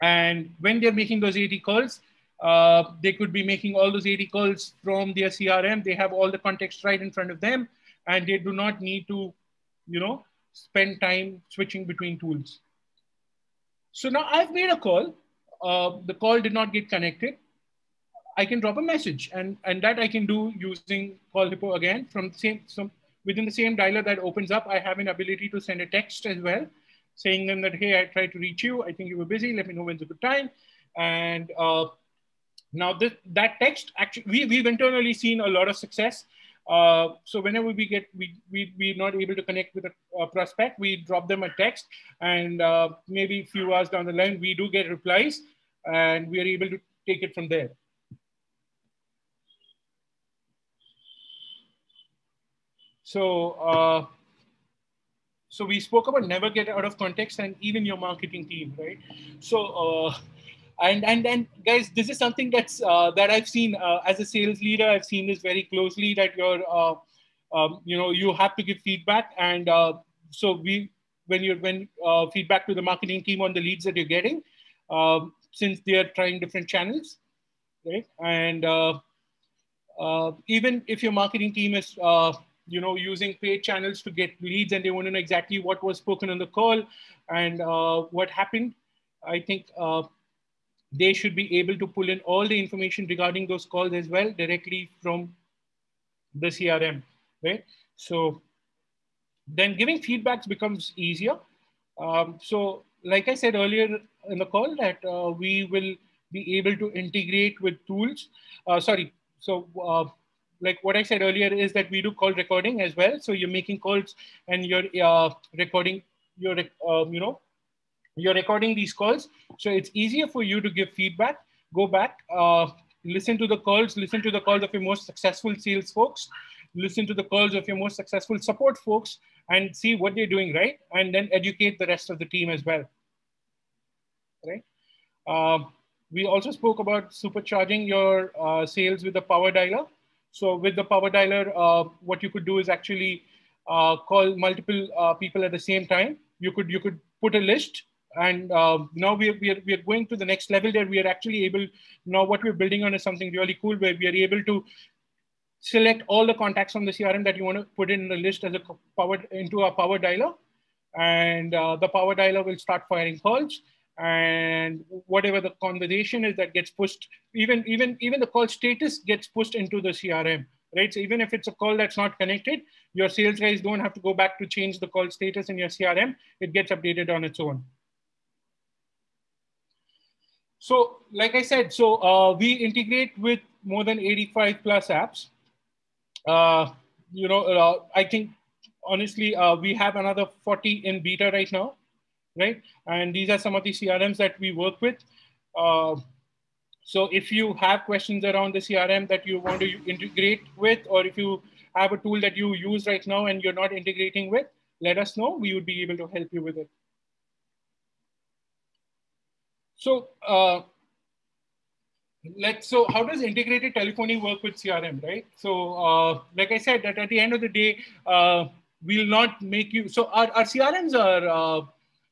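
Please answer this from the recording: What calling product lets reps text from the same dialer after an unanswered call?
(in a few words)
Call Hippo.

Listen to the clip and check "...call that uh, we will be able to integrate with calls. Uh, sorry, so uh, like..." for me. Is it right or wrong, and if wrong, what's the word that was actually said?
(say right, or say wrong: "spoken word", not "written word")
wrong: "tools", not "calls".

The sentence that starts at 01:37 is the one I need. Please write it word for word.
So then giving feedbacks becomes easier.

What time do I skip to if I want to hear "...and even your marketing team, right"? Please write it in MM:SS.
00:57.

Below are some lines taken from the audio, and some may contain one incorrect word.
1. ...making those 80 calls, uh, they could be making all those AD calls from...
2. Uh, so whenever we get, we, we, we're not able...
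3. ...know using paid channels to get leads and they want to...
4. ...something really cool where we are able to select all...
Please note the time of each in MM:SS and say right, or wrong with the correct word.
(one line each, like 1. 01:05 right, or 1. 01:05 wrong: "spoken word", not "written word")
1. 00:00 right
2. 00:36 right
3. 01:22 right
4. 02:33 right.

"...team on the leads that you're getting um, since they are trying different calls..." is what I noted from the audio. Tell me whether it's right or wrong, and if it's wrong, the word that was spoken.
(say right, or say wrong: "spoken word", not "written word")
wrong: "channels", not "calls".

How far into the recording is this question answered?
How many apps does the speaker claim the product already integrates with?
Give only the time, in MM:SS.
03:03.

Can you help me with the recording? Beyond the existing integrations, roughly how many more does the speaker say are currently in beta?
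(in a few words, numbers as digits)
40.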